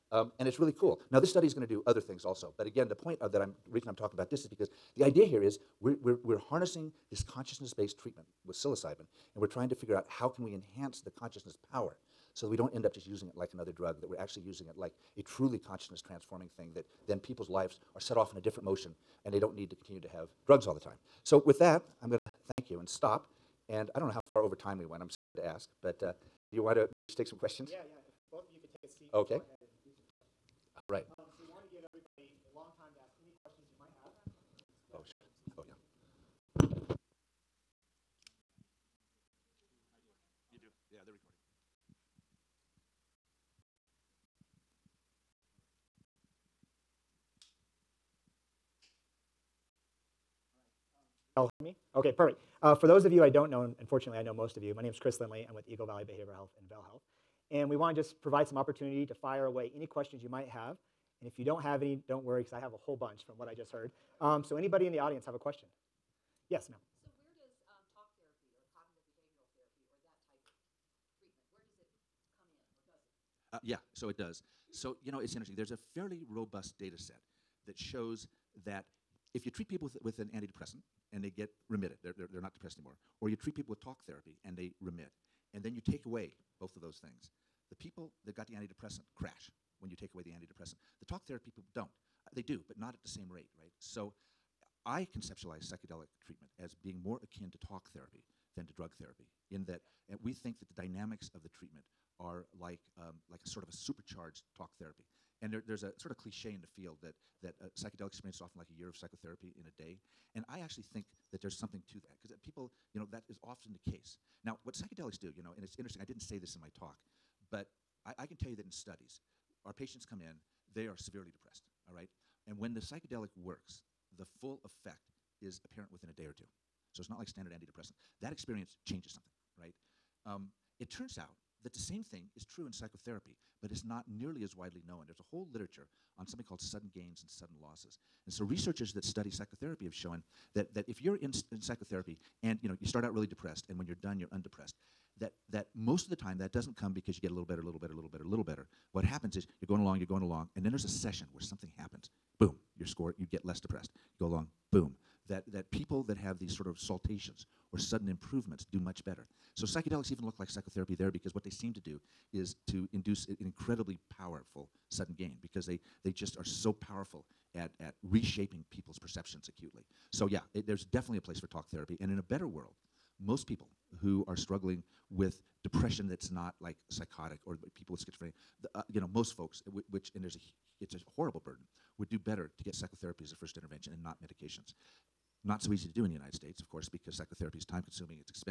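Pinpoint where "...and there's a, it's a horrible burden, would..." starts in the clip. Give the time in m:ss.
3:00.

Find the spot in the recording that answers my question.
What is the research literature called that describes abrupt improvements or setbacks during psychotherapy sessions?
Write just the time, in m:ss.
2:16.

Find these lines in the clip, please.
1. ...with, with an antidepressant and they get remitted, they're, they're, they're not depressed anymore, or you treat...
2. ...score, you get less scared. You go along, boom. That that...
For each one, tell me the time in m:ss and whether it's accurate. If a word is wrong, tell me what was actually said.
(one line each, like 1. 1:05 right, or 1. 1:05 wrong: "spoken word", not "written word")
1. 1:19 right
2. 2:32 wrong: "depressed", not "scared".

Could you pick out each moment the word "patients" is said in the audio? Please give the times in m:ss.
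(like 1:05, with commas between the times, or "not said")
1:59.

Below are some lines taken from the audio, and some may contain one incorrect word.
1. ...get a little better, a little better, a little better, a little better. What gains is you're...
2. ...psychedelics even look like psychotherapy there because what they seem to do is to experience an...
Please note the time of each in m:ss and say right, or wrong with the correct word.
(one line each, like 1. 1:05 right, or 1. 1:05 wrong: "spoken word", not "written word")
1. 2:27 wrong: "happens", not "gains"
2. 2:39 wrong: "induce", not "experience".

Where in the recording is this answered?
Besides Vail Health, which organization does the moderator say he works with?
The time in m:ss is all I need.
0:55.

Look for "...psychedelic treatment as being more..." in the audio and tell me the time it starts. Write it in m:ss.
1:35.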